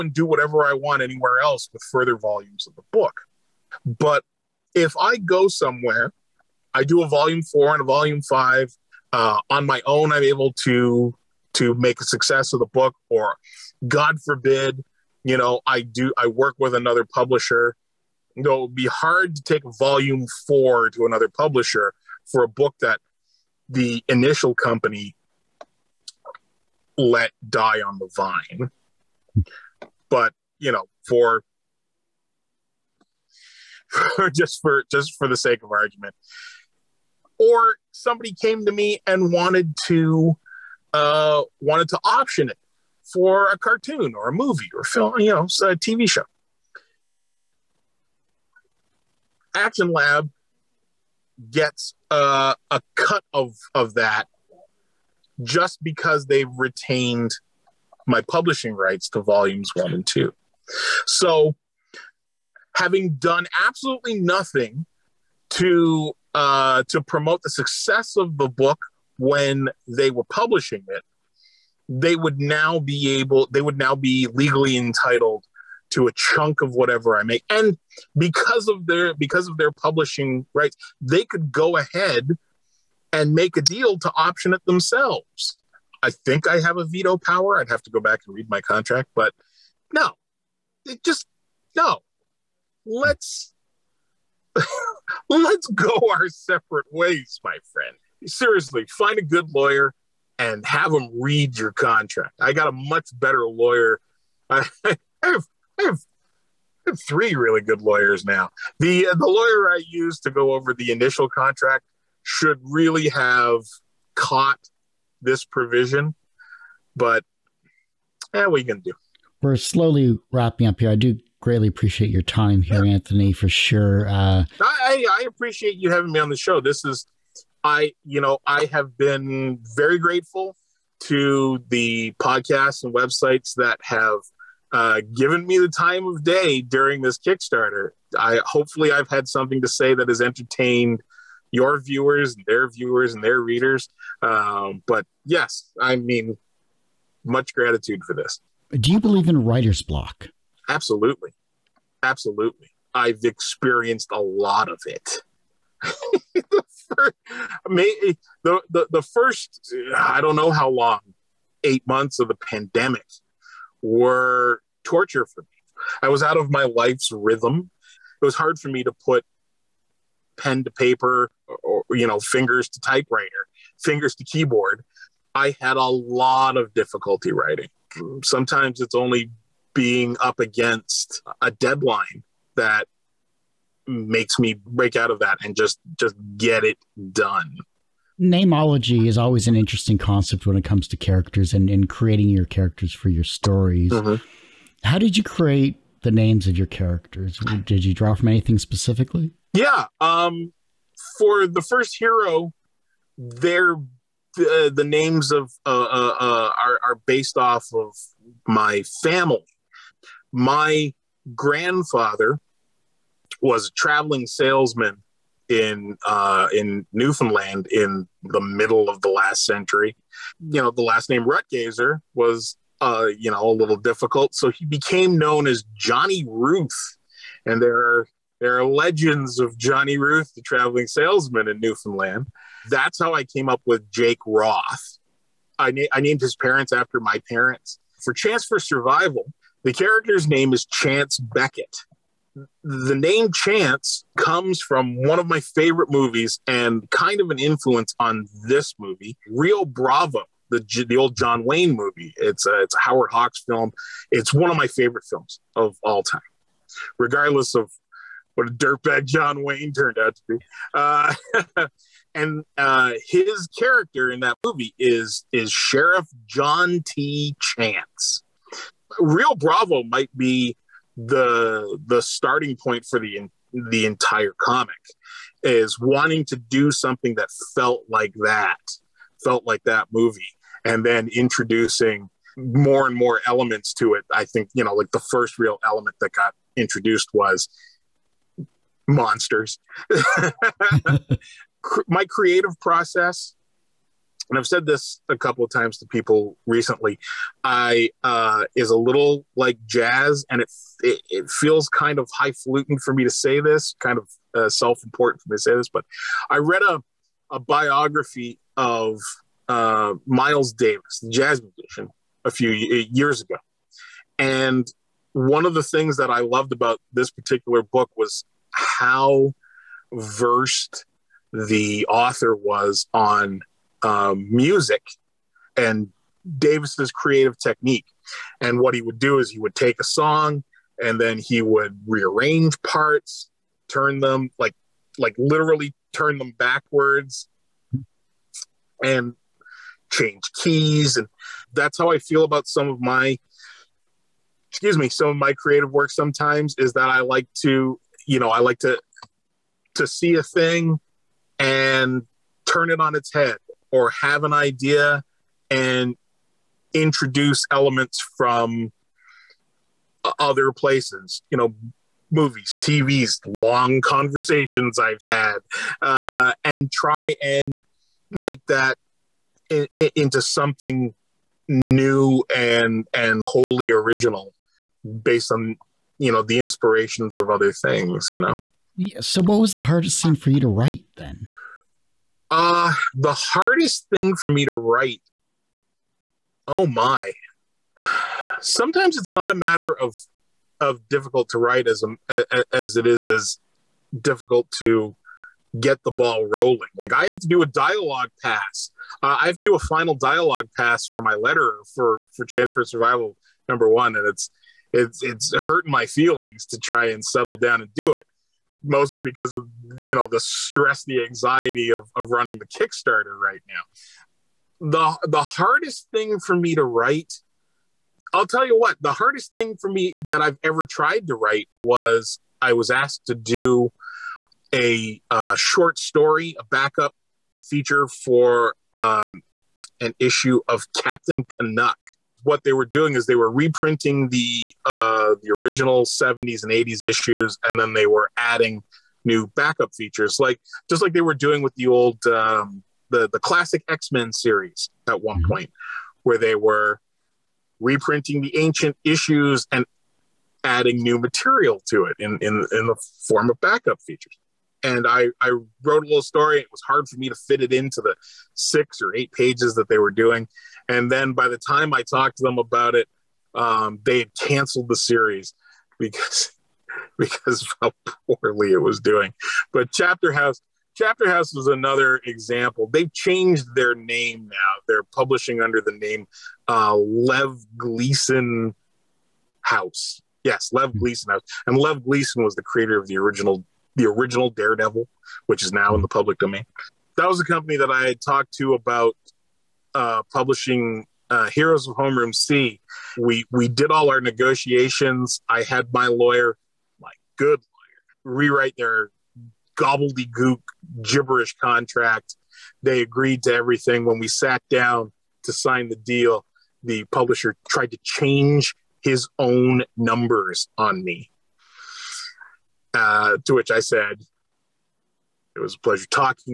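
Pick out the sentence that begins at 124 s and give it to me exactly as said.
Uh, I, I appreciate you having me on the show.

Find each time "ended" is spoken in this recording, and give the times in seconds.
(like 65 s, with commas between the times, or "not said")
not said.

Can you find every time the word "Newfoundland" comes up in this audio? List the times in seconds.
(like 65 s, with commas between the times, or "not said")
216 s, 231 s.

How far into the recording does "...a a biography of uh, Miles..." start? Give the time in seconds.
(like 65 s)
306 s.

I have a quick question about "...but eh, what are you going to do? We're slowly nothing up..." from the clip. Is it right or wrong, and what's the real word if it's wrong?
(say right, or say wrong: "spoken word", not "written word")
wrong: "wrapping", not "nothing".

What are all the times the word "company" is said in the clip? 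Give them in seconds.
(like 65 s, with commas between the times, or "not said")
24 s, 487 s.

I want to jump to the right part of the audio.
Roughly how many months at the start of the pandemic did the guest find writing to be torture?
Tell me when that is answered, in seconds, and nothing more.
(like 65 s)
161 s.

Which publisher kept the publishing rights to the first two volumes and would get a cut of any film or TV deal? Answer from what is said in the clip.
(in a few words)
Action Lab.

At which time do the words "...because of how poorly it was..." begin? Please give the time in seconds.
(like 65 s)
466 s.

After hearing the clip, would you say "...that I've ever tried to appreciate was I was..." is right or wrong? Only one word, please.
wrong.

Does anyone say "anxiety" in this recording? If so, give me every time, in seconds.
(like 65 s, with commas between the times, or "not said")
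411 s.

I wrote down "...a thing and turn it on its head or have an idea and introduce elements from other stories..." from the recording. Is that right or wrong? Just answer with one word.
wrong.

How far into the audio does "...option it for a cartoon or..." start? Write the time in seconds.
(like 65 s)
42 s.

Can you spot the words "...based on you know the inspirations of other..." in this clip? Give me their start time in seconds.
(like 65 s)
375 s.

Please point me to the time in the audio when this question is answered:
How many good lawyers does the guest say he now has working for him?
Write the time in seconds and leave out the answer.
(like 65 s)
107 s.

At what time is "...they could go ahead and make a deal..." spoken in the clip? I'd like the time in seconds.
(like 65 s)
80 s.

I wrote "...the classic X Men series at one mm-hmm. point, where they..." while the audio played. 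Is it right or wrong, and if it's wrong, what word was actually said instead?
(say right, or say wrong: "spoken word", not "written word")
right.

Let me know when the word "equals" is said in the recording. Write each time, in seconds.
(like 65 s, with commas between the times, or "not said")
not said.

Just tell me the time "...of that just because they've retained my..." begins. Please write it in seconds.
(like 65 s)
53 s.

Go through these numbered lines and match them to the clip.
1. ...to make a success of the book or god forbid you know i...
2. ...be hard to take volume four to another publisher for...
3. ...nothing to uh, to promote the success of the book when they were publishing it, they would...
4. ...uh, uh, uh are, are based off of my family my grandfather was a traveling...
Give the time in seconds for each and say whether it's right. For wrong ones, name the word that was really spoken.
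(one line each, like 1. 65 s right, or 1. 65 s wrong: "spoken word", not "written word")
1. 11 s right
2. 18 s right
3. 64 s right
4. 205 s right.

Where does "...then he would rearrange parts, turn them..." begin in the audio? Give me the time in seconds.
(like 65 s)
330 s.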